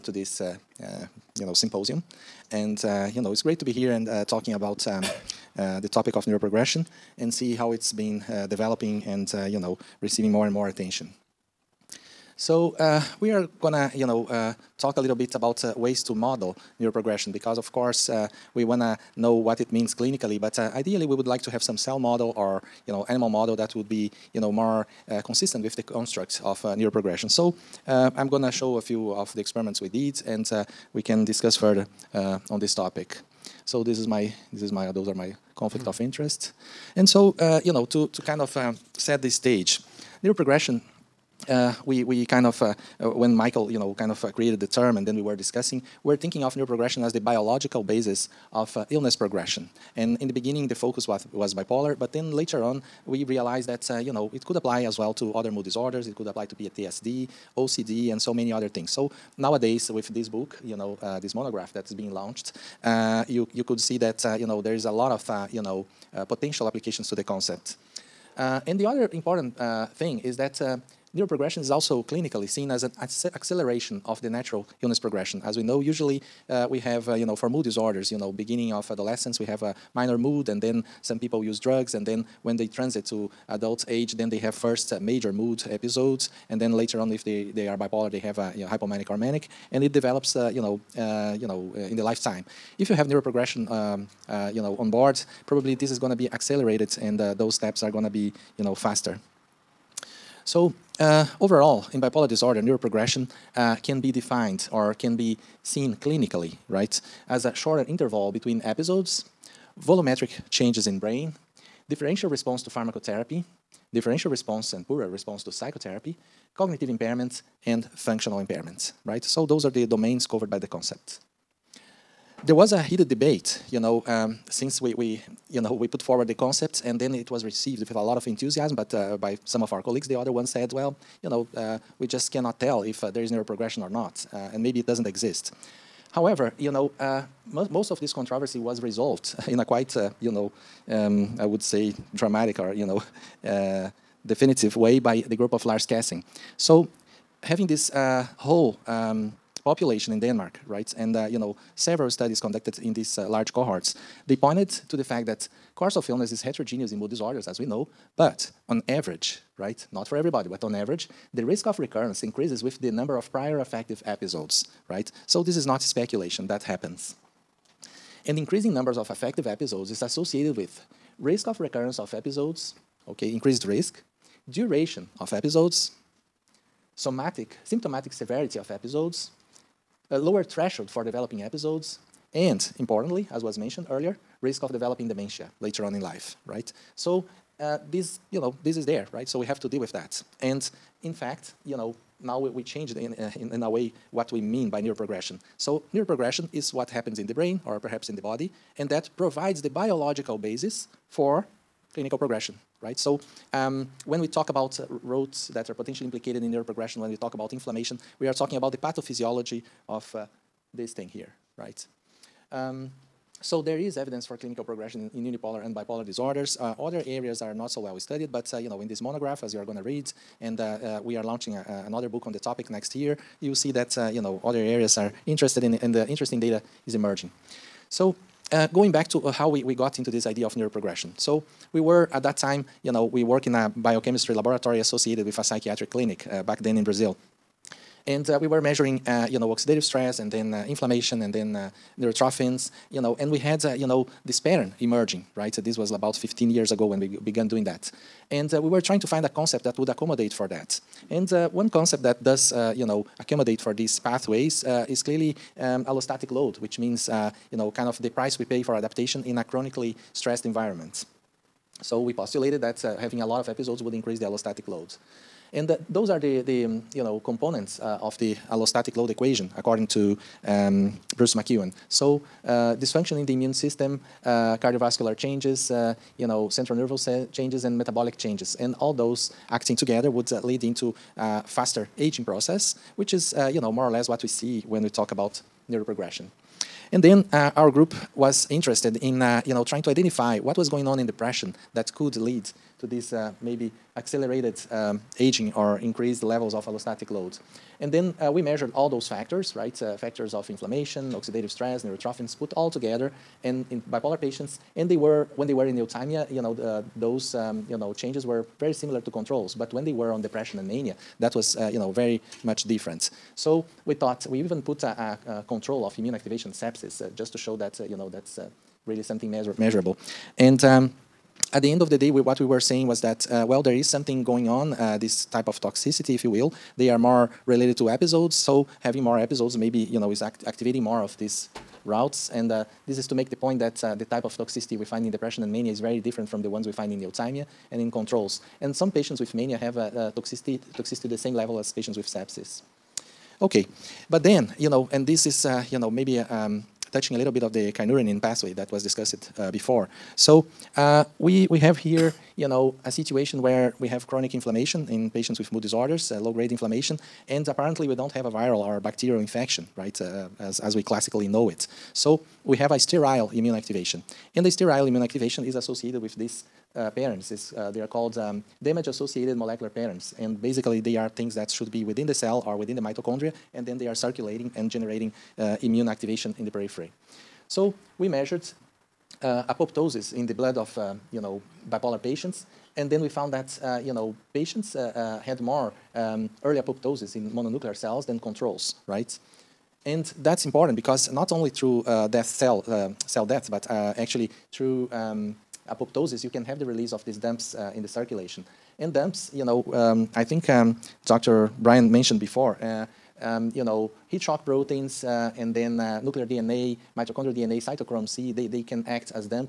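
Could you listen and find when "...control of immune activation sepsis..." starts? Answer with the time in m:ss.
5:15.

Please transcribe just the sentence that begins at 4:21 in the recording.
So we postulated that uh, having a lot of episodes would increase the allostatic load.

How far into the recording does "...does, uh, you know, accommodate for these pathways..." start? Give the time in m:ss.
4:12.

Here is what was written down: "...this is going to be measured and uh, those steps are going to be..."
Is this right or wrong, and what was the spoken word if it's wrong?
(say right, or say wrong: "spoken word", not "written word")
wrong: "accelerated", not "measured".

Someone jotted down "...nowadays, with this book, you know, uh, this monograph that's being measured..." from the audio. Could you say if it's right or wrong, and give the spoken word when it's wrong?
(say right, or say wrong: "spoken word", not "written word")
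wrong: "launched", not "measured".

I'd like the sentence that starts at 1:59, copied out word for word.
So those are the domains covered by the concept.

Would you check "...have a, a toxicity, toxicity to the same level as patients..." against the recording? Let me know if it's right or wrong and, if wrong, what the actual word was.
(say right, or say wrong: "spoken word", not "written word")
right.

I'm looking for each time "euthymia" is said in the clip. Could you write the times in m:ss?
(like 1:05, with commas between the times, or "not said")
5:05, 5:37.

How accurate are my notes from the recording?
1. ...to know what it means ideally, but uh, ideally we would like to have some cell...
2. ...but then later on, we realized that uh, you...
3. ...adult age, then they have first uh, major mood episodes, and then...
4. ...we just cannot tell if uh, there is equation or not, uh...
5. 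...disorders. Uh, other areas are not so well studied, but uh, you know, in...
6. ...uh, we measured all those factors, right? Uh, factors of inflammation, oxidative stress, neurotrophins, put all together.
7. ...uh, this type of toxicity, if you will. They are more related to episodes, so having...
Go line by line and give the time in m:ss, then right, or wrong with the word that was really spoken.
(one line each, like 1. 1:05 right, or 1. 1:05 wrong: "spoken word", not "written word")
1. 0:18 wrong: "clinically", not "ideally"
2. 0:51 right
3. 1:23 right
4. 2:11 wrong: "neuroprogression", not "equation"
5. 3:36 right
6. 4:58 right
7. 5:24 right.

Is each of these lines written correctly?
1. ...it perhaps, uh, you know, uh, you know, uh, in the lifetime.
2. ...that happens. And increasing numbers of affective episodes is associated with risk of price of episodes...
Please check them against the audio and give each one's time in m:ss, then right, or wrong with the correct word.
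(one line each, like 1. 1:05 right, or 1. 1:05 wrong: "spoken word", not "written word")
1. 1:29 wrong: "develops", not "perhaps"
2. 2:46 wrong: "recurrence", not "price".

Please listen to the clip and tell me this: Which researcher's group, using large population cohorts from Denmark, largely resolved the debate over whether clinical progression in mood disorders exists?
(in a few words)
Lars Kessing.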